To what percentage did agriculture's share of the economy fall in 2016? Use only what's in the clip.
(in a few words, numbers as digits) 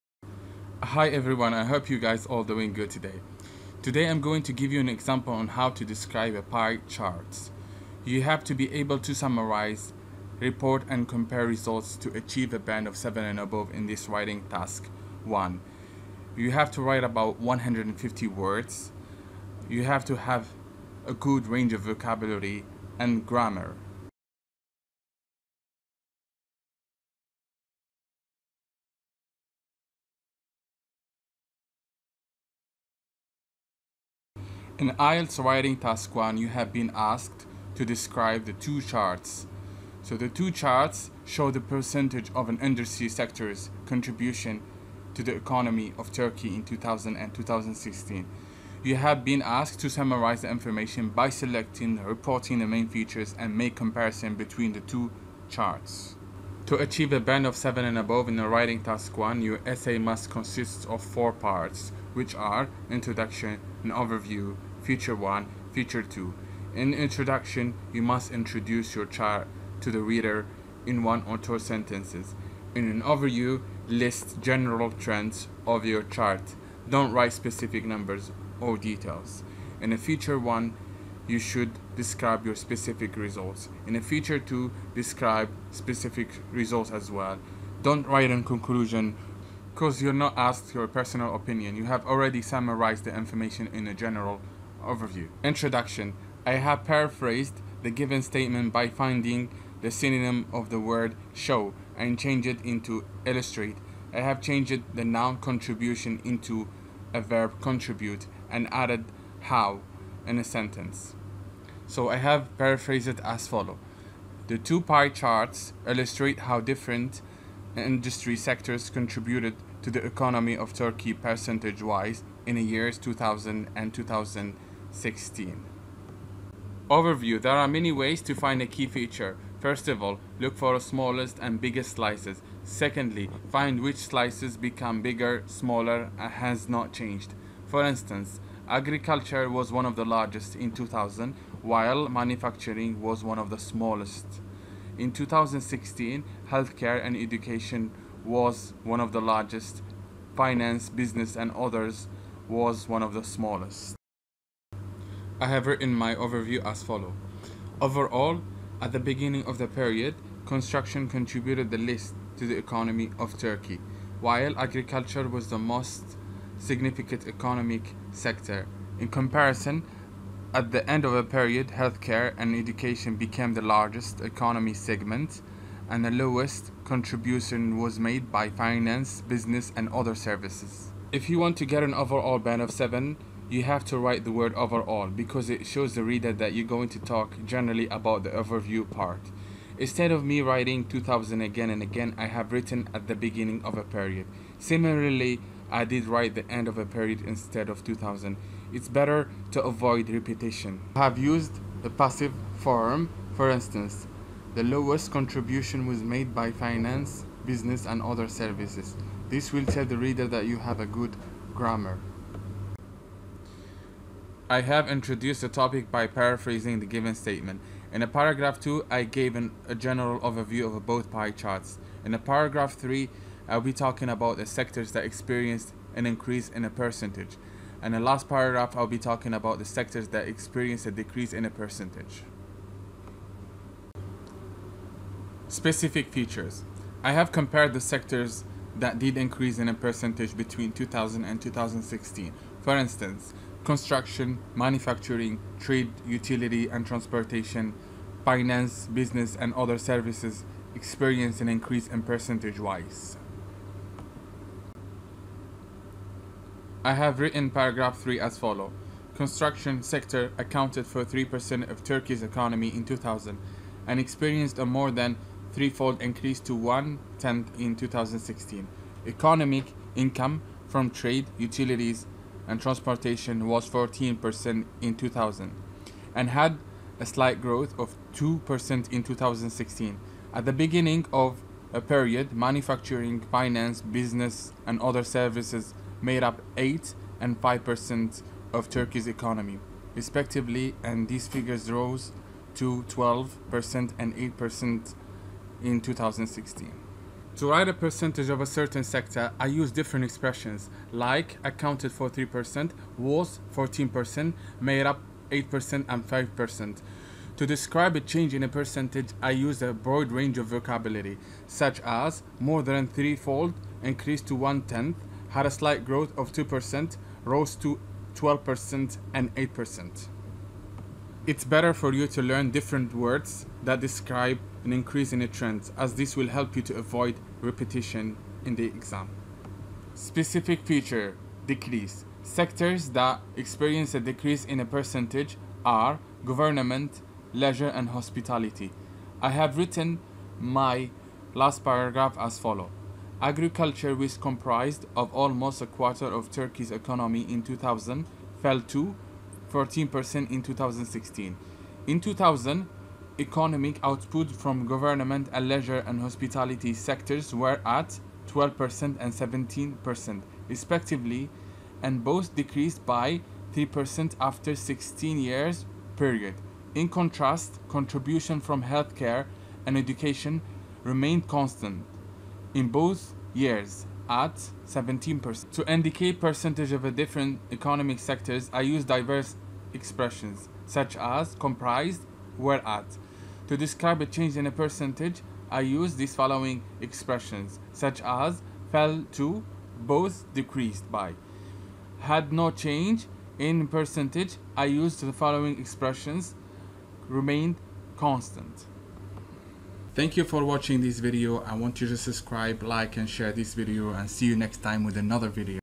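14%.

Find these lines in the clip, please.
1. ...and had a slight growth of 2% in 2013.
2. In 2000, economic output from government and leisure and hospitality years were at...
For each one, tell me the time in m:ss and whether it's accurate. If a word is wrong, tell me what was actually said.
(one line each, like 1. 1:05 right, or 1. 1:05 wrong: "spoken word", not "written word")
1. 4:36 wrong: "2016", not "2013"
2. 5:51 wrong: "sectors", not "years".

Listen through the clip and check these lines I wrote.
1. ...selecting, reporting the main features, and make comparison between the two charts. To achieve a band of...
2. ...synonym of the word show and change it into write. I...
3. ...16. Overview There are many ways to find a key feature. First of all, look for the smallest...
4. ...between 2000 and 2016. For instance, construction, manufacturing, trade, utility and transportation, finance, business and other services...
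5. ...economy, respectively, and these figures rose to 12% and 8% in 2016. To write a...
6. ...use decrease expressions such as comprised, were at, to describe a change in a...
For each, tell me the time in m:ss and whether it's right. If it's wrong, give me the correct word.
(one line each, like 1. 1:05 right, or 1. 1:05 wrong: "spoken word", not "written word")
1. 0:51 right
2. 1:39 wrong: "illustrate", not "write"
3. 2:04 right
4. 4:00 right
5. 4:49 right
6. 6:18 wrong: "diverse", not "decrease".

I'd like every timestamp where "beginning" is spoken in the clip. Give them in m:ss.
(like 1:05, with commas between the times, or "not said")
2:38, 3:13, 4:40.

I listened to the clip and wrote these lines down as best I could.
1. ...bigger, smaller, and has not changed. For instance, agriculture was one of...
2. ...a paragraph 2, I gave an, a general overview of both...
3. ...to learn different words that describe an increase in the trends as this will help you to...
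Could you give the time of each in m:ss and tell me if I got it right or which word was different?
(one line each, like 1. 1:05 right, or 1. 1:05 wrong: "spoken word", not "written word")
1. 2:15 right
2. 3:38 right
3. 5:22 right.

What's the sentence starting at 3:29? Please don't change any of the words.
This will tell the reader that you have a good grammar.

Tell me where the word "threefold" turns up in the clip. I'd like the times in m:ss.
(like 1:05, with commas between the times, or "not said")
4:25, 5:12.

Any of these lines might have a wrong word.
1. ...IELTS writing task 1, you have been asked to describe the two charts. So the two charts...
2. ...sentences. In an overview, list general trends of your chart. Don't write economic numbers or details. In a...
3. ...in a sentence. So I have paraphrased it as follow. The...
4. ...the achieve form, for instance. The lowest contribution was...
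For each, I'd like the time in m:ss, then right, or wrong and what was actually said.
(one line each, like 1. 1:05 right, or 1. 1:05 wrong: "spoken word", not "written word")
1. 0:34 right
2. 1:11 wrong: "specific", not "economic"
3. 1:50 right
4. 3:21 wrong: "passive", not "achieve".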